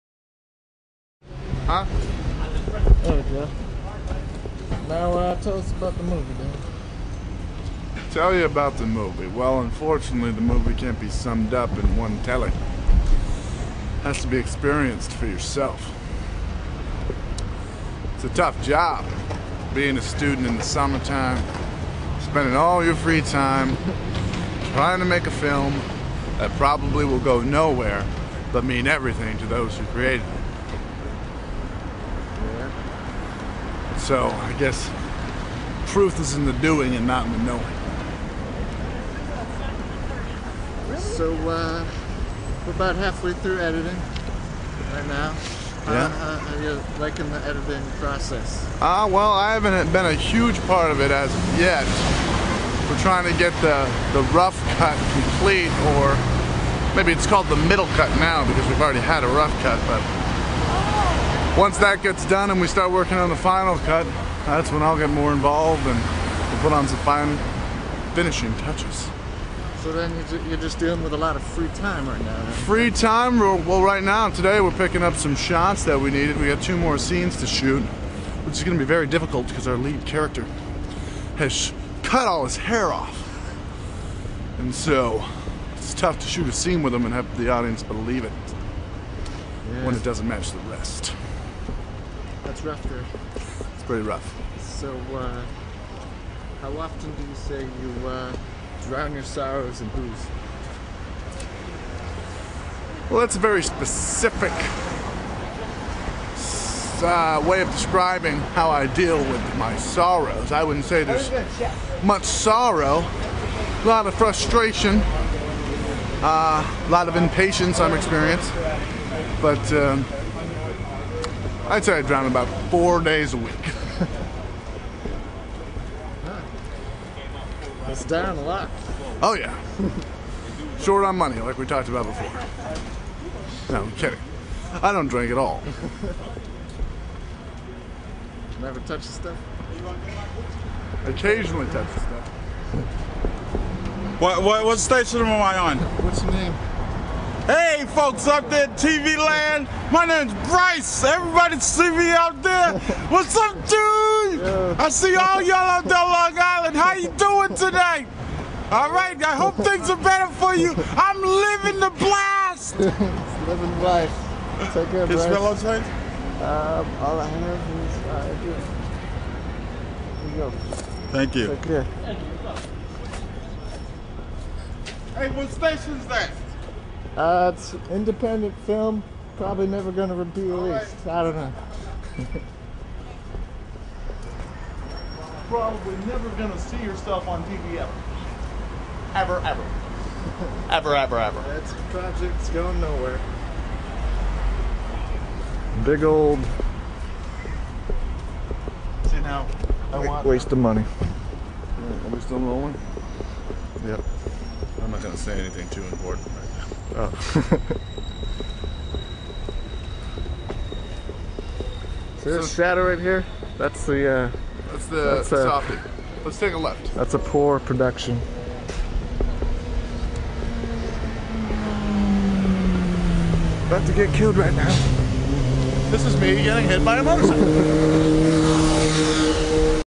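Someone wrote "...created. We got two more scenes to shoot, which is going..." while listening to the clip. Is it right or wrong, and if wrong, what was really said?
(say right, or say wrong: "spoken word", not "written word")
wrong: "needed", not "created".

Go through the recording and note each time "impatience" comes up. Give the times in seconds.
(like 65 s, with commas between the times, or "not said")
117 s.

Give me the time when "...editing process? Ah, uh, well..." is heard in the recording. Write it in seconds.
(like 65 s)
47 s.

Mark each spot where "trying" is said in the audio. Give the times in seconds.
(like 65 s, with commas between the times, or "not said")
24 s, 53 s.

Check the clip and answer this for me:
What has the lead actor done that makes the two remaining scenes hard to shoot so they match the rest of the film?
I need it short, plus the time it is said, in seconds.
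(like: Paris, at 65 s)
cut all his hair off, at 82 s.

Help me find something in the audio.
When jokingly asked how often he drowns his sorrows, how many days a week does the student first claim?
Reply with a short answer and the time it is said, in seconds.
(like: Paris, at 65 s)
4, at 122 s.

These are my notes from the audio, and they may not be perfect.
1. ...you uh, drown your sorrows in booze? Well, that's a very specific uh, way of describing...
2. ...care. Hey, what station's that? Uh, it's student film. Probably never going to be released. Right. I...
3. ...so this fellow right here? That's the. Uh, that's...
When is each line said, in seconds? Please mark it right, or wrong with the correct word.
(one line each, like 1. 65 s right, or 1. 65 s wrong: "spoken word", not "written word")
1. 97 s right
2. 171 s wrong: "independent", not "student"
3. 212 s wrong: "shadow", not "fellow".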